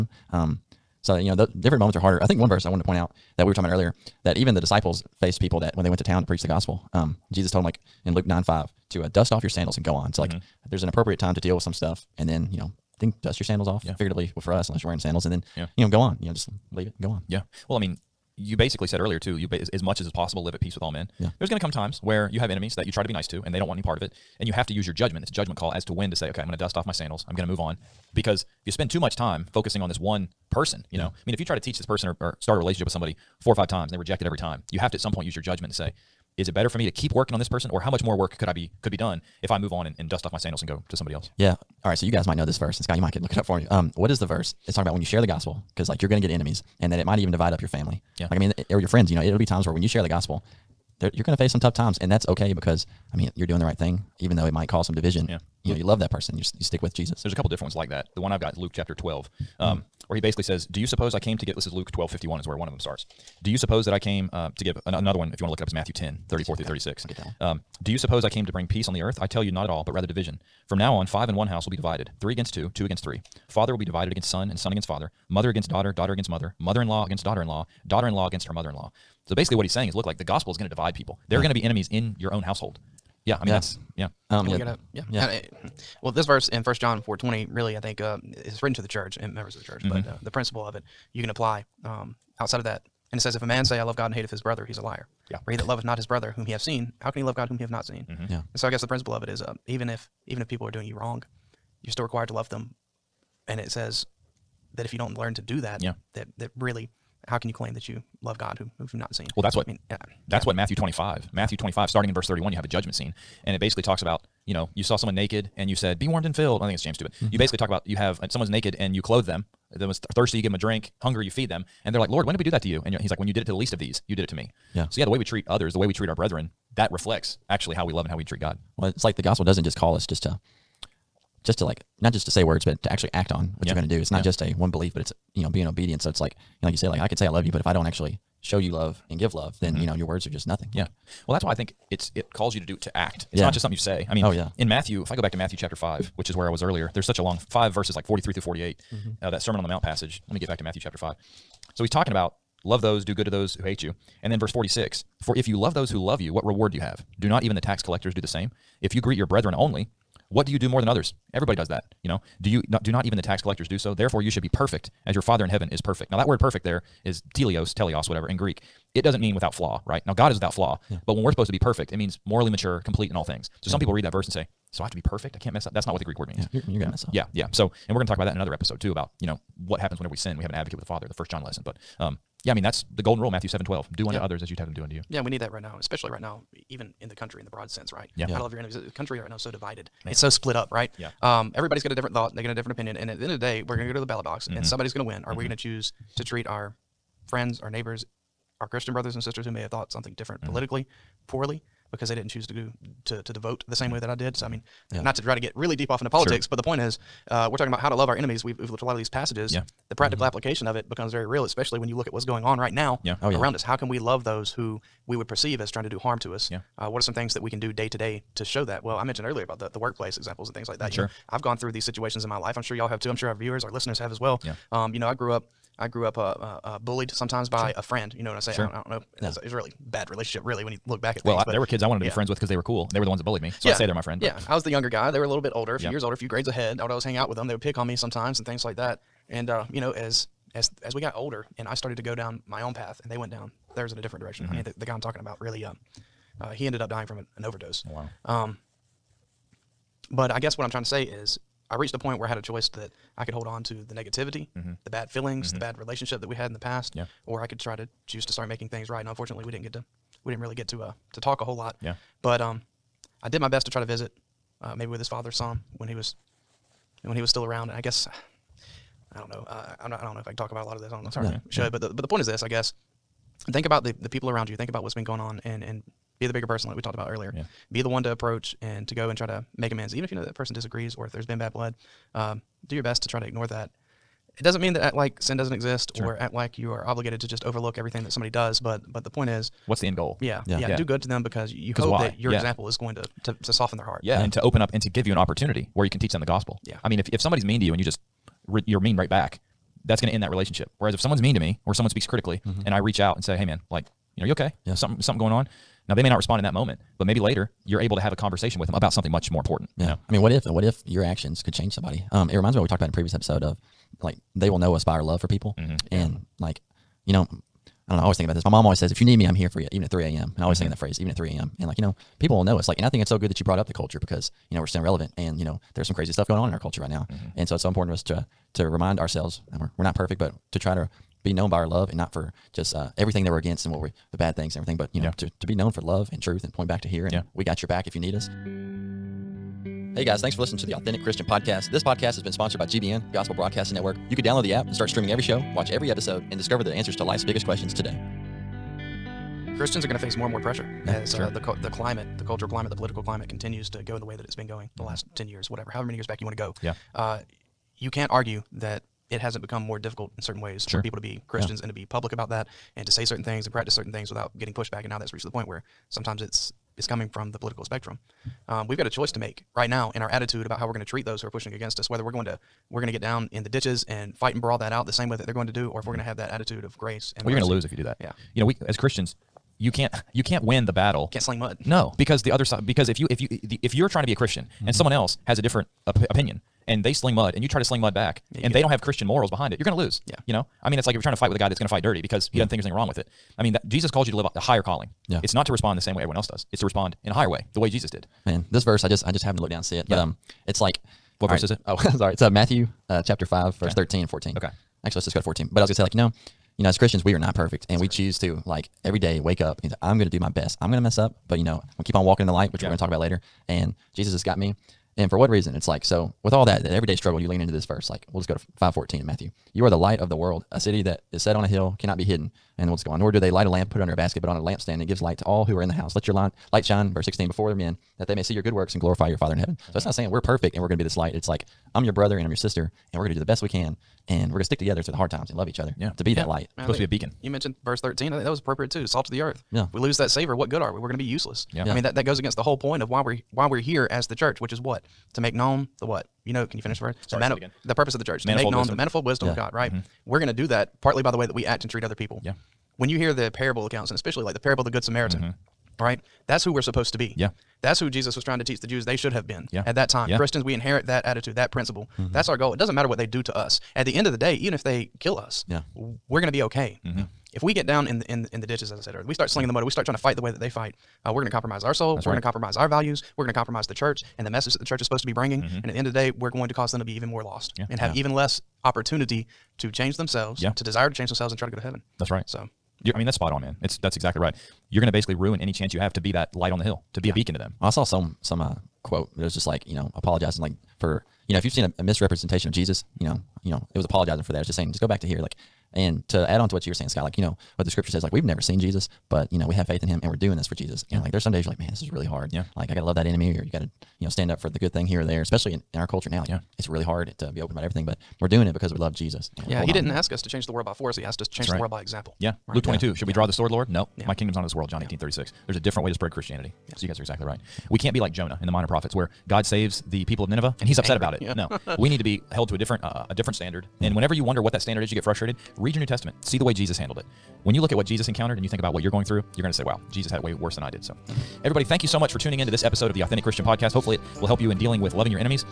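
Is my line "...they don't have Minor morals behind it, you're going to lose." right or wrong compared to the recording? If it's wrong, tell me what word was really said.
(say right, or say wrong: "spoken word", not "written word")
wrong: "Christian", not "Minor".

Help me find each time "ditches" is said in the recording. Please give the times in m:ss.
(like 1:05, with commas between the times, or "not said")
6:13, 7:48.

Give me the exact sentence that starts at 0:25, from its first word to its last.
It's a judgment call as to when to say, okay, I'm going to dust off my sandals.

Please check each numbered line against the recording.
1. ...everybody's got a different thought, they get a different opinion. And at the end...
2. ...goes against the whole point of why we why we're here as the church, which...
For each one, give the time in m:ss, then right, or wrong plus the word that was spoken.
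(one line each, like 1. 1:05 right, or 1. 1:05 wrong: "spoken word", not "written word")
1. 3:11 right
2. 7:22 right.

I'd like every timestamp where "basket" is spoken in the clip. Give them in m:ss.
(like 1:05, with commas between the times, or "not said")
7:03.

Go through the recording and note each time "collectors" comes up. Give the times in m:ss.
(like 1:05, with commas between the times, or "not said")
2:37, 2:43.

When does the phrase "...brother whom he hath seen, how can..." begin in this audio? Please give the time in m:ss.
1:36.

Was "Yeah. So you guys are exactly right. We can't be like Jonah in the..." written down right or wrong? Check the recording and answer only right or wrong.
right.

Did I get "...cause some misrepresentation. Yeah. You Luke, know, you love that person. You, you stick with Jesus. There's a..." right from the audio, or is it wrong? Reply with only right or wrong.
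wrong.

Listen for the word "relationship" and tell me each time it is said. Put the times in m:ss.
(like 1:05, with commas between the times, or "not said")
0:32, 3:50, 4:15, 5:00.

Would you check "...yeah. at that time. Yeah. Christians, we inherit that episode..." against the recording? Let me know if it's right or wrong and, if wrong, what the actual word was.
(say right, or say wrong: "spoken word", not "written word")
wrong: "attitude", not "episode".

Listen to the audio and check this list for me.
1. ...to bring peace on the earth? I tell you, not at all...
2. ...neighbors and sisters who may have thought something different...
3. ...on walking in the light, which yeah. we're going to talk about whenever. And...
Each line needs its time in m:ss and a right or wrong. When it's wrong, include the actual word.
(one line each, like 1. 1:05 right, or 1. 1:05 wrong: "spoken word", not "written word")
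1. 1:08 right
2. 3:18 wrong: "brothers", not "neighbors"
3. 6:51 wrong: "later", not "whenever".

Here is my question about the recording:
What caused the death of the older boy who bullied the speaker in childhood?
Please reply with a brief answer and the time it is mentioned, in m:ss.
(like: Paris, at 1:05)
An overdose, at 4:07.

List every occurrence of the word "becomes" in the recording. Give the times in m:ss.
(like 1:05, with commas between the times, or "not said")
3:30, 5:59.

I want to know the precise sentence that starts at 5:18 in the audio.
My mom always says, If you need me, I'm here for you, even at three AM.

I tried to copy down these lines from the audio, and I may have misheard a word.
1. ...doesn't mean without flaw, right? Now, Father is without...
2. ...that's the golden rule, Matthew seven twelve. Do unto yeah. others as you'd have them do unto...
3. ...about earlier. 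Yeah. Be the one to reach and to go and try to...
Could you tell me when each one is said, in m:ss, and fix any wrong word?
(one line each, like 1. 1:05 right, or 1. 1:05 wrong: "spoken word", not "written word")
1. 2:49 wrong: "God", not "Father"
2. 3:02 right
3. 4:36 wrong: "approach", not "reach".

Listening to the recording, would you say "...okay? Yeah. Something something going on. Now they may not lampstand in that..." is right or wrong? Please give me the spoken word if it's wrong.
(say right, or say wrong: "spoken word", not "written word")
wrong: "respond", not "lampstand".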